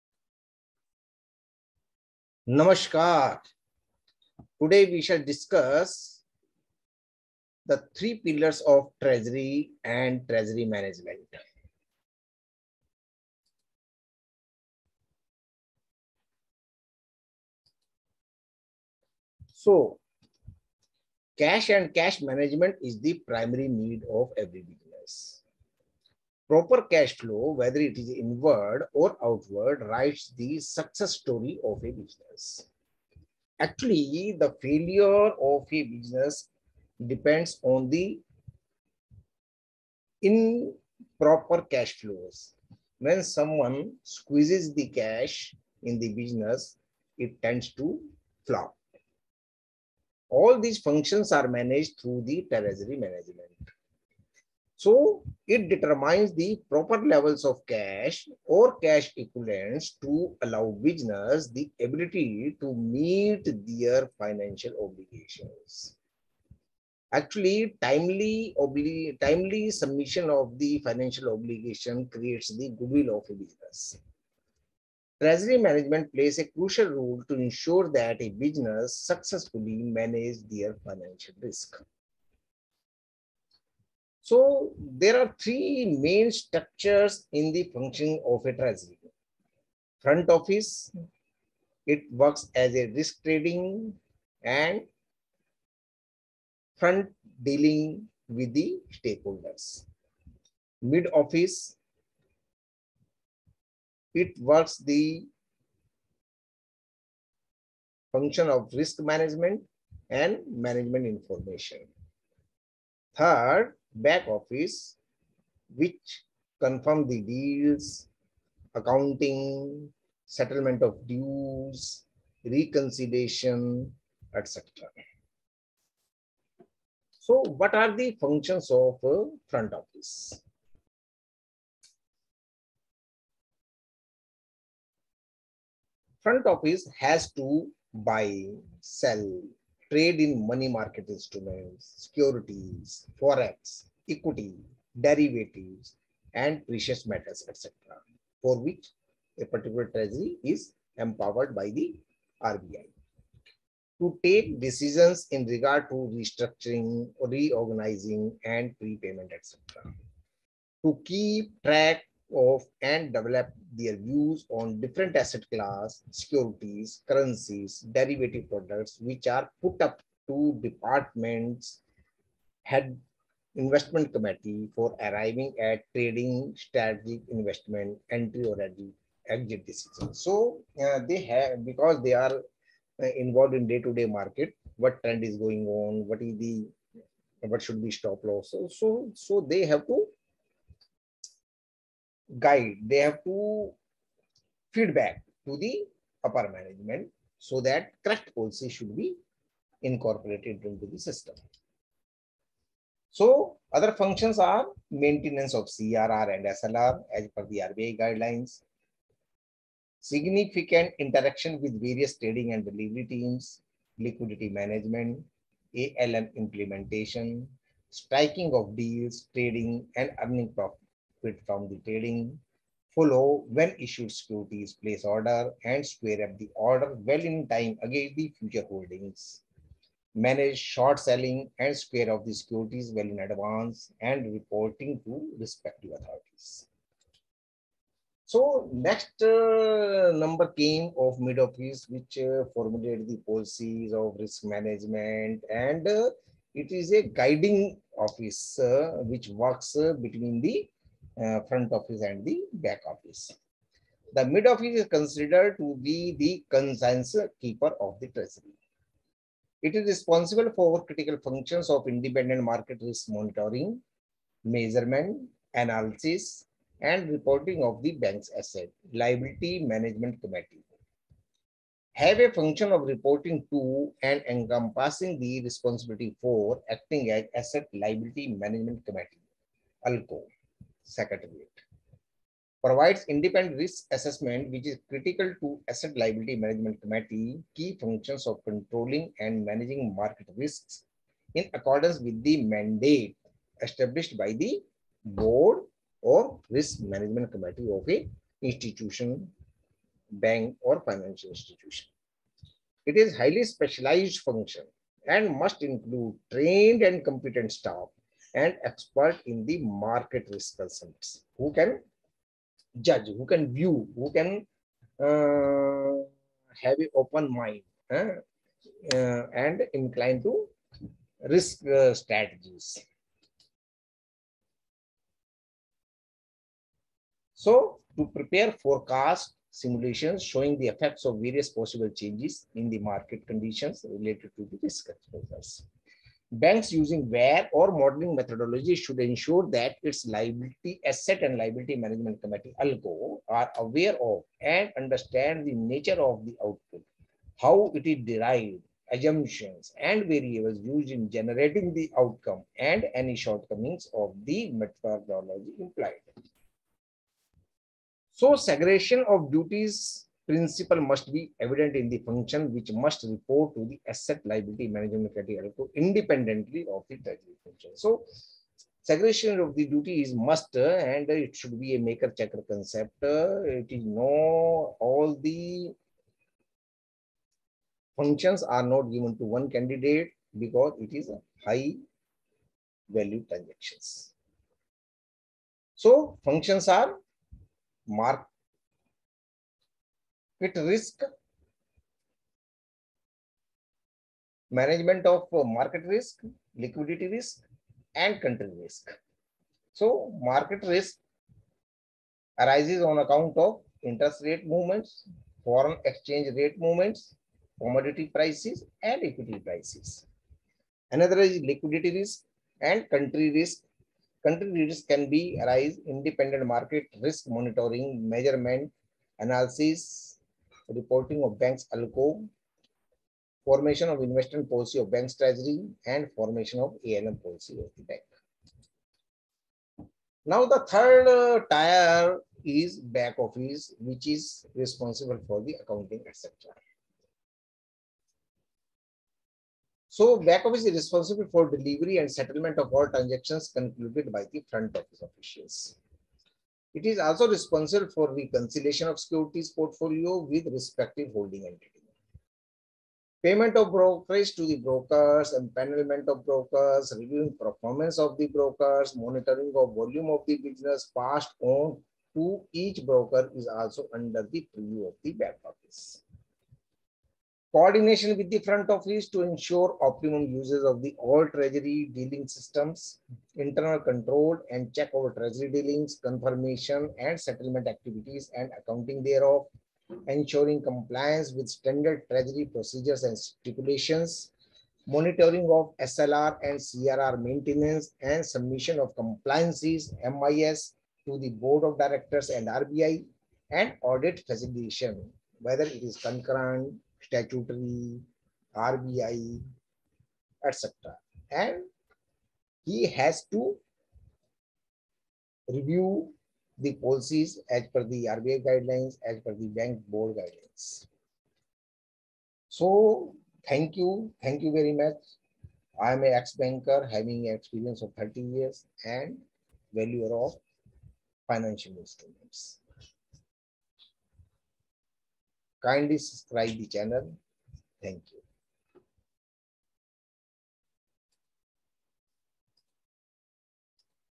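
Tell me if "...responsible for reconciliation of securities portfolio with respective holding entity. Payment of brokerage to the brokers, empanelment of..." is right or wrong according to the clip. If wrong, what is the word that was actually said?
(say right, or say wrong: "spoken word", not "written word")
right.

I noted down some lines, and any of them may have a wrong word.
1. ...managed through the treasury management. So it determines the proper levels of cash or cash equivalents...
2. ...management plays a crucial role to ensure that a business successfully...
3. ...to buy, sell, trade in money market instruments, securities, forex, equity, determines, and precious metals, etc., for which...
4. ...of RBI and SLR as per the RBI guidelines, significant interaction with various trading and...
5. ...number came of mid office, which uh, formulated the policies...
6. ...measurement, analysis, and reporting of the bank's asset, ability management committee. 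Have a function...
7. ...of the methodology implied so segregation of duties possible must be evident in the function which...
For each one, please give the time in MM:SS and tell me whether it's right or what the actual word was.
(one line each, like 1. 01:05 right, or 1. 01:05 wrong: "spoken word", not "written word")
1. 00:51 right
2. 01:15 right
3. 02:17 wrong: "derivatives", not "determines"
4. 03:25 wrong: "CRR", not "RBI"
5. 04:00 right
6. 04:24 wrong: "liability", not "ability"
7. 05:53 wrong: "principle", not "possible".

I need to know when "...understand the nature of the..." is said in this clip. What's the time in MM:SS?
05:44.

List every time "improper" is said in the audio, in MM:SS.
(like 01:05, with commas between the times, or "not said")
00:40.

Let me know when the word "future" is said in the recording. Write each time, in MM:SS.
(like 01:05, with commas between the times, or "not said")
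03:48.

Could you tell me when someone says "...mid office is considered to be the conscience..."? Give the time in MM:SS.
04:14.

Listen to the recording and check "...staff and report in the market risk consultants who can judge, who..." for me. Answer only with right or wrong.
wrong.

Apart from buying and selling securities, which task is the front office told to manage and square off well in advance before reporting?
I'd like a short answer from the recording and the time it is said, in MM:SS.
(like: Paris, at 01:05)
Short selling, at 03:50.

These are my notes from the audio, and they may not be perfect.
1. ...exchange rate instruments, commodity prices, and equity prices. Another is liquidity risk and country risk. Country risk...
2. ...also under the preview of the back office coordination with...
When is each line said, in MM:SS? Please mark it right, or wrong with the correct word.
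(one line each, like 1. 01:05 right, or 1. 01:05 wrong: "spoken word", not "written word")
1. 06:45 wrong: "movements", not "instruments"
2. 07:43 right.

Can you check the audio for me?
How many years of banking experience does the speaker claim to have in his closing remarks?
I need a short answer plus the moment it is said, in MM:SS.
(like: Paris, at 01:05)
30, at 08:37.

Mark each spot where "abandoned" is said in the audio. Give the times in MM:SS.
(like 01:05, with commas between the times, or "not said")
not said.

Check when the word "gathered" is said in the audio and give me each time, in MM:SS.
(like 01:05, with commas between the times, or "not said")
not said.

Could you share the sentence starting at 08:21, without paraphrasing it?
And he has to review the policies as per the RBI guidelines, as per the bank board guidelines.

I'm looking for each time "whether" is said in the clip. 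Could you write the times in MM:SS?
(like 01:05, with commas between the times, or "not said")
00:27, 08:15.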